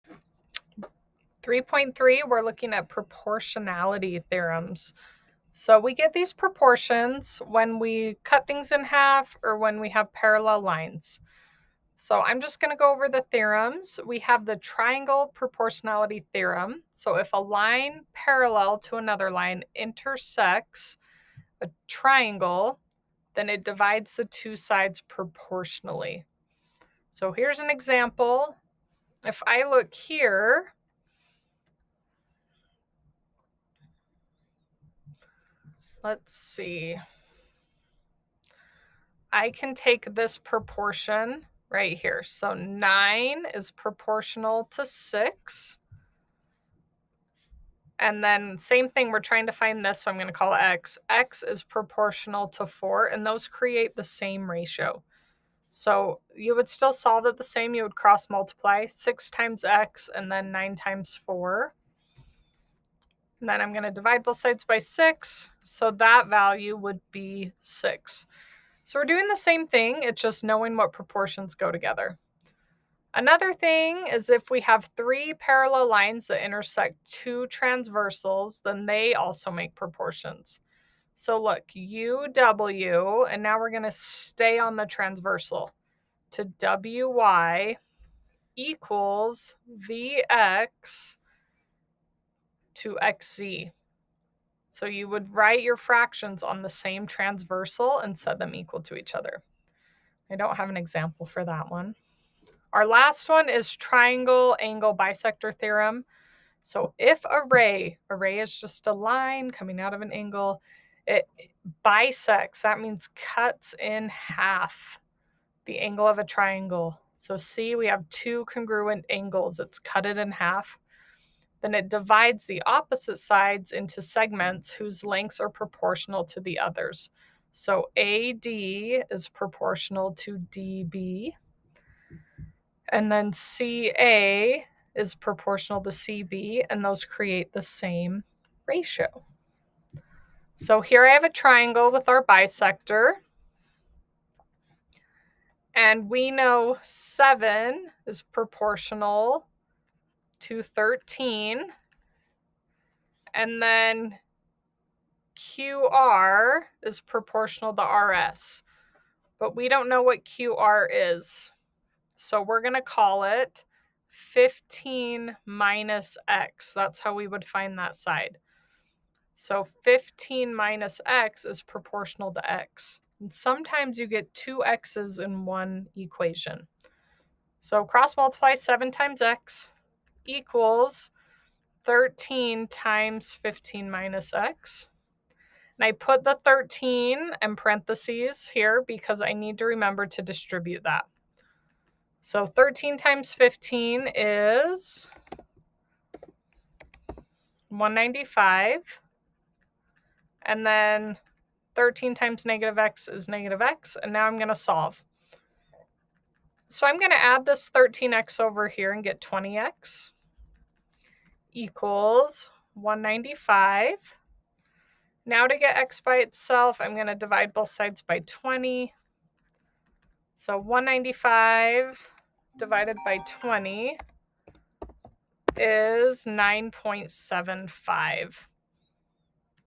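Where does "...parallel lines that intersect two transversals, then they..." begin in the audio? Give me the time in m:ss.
1:15.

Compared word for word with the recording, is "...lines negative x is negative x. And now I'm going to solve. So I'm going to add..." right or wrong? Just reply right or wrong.
wrong.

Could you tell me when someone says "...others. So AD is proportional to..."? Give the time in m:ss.
2:06.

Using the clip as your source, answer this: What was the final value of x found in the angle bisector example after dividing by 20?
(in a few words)
9.75.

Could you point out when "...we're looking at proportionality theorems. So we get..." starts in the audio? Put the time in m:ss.
0:02.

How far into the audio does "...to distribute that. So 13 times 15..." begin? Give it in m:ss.
3:10.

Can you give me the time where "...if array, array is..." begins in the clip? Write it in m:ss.
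1:46.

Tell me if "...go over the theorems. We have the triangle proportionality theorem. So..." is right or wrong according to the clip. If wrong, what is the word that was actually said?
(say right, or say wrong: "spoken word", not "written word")
right.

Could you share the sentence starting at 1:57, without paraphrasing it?
So see, we have two congruent angles.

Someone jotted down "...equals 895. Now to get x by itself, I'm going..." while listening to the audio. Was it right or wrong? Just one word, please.
wrong.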